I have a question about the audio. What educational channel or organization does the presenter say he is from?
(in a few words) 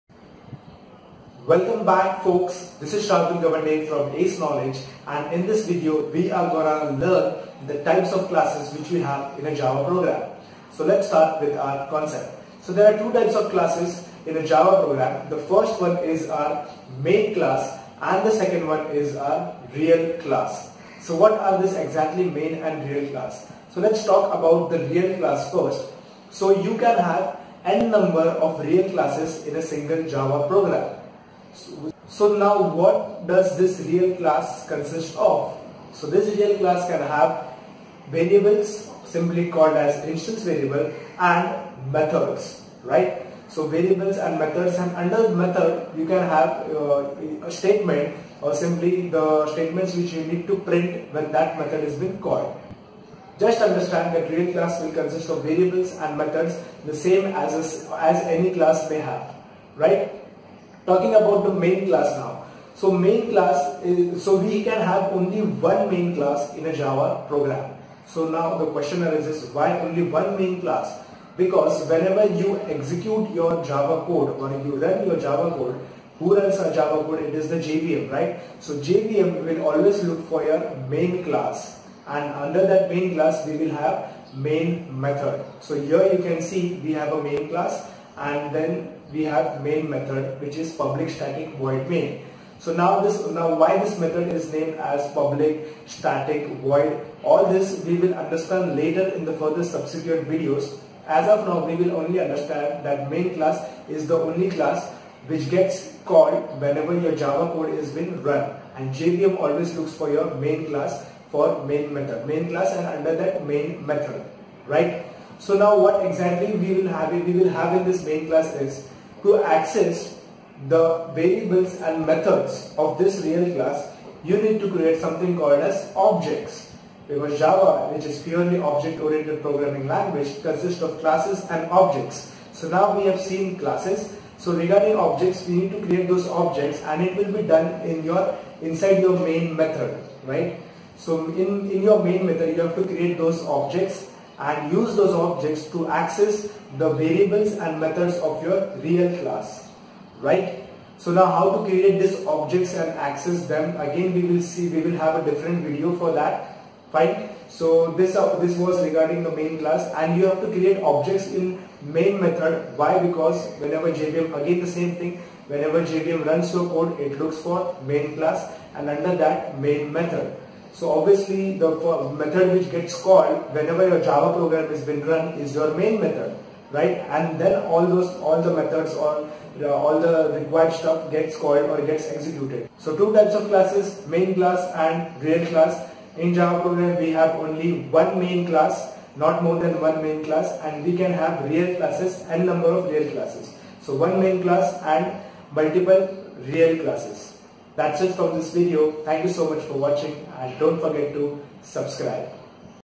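ACE Knowledge.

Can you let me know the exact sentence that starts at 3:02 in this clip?
So two types of classes, main class and real class.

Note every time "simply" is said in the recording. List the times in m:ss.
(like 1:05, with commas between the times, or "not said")
0:39, 0:48.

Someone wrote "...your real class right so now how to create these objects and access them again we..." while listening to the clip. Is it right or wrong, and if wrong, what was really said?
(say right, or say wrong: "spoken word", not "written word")
right.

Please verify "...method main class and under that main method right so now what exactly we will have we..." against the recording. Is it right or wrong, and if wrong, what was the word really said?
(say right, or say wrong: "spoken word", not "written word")
right.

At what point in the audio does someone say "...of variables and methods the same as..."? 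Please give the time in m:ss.
0:55.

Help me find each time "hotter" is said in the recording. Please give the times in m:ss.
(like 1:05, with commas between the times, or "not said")
not said.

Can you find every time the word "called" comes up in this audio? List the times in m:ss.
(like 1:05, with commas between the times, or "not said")
0:39, 0:52, 1:46, 2:05, 2:52, 3:01.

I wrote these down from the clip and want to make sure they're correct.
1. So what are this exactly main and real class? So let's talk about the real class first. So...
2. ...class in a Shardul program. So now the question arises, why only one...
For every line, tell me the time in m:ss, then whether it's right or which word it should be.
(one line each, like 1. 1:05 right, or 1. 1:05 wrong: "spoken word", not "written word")
1. 0:21 right
2. 1:06 wrong: "Java", not "Shardul".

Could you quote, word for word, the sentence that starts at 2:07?
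Because Java, which is purely object-oriented programming language, consists of classes and objects.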